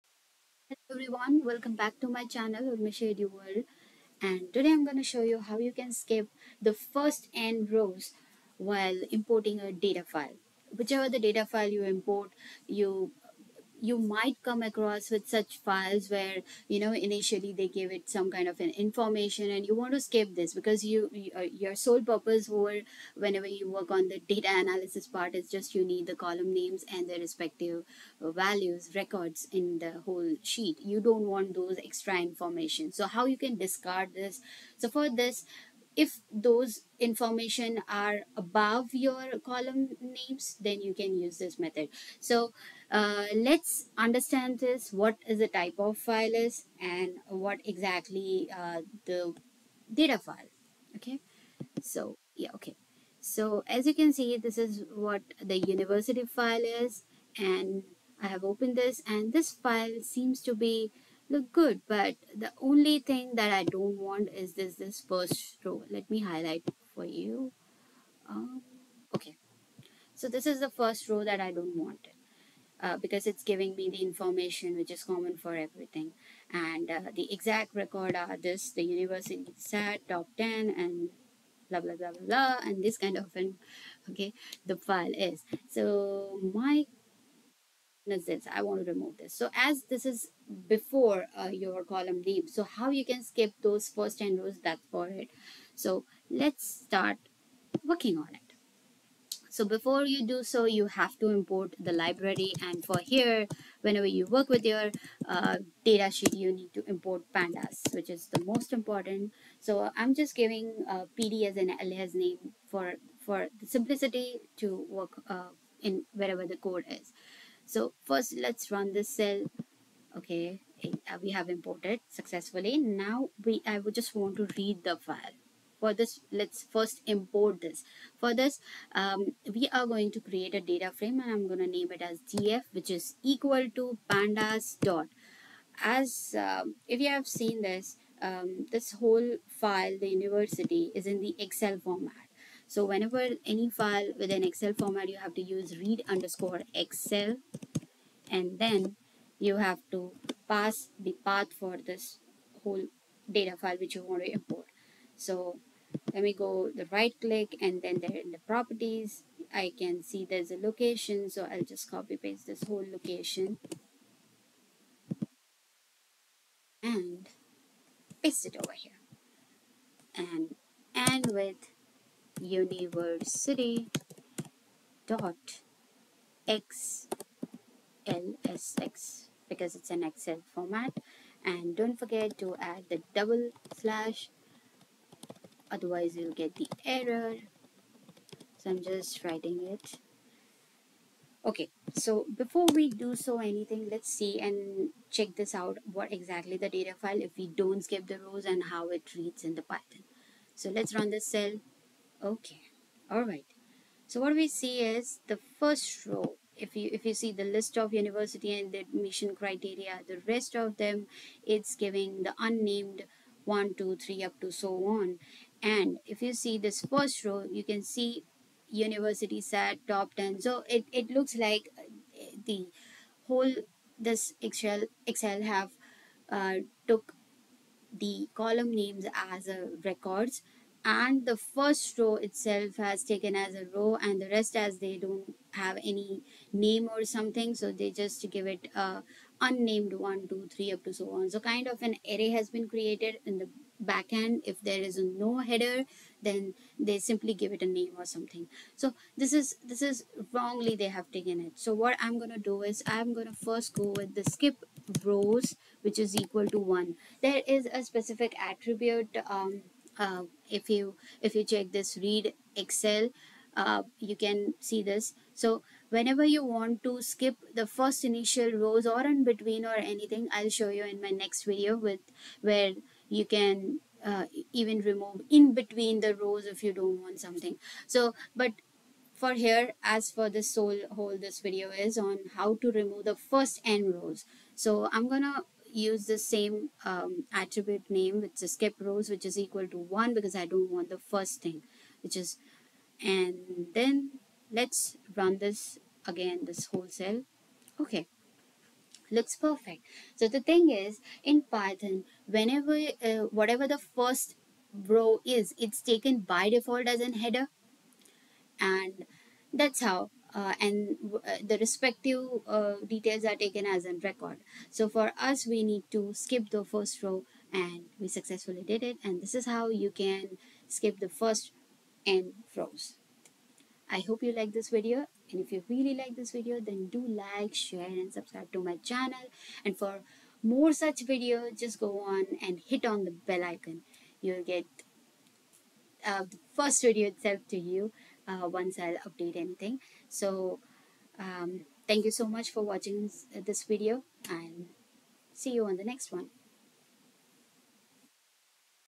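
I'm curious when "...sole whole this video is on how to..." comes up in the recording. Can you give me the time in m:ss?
4:40.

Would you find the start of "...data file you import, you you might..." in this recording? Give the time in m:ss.
0:11.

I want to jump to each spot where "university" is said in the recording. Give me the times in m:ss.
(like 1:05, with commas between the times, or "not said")
0:55, 1:18, 2:20, 2:52, 3:27, 3:38.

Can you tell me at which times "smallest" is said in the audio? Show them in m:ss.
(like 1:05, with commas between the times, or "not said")
not said.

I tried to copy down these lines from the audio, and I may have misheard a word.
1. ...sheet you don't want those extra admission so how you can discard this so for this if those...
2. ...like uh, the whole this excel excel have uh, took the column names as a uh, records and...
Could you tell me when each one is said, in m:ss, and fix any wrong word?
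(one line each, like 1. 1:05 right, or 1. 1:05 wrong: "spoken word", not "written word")
1. 0:30 wrong: "information", not "admission"
2. 3:41 right.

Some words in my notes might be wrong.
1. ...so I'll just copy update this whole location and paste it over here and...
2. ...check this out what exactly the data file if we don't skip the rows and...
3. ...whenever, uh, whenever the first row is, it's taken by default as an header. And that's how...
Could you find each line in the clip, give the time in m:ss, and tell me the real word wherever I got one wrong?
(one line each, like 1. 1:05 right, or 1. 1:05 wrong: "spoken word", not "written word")
1. 2:41 wrong: "paste", not "update"
2. 3:15 right
3. 5:02 wrong: "whatever", not "whenever".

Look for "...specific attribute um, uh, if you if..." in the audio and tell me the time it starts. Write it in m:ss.
4:17.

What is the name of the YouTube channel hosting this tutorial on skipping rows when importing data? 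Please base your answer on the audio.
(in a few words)
Urmisha Eduworld.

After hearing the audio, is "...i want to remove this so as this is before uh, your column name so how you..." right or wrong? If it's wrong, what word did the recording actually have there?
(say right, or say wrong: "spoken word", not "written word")
right.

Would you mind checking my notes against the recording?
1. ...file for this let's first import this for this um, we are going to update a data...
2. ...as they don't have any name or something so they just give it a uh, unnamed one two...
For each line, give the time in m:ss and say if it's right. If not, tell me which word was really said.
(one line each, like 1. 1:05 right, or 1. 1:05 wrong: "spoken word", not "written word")
1. 2:04 wrong: "create", not "update"
2. 3:54 right.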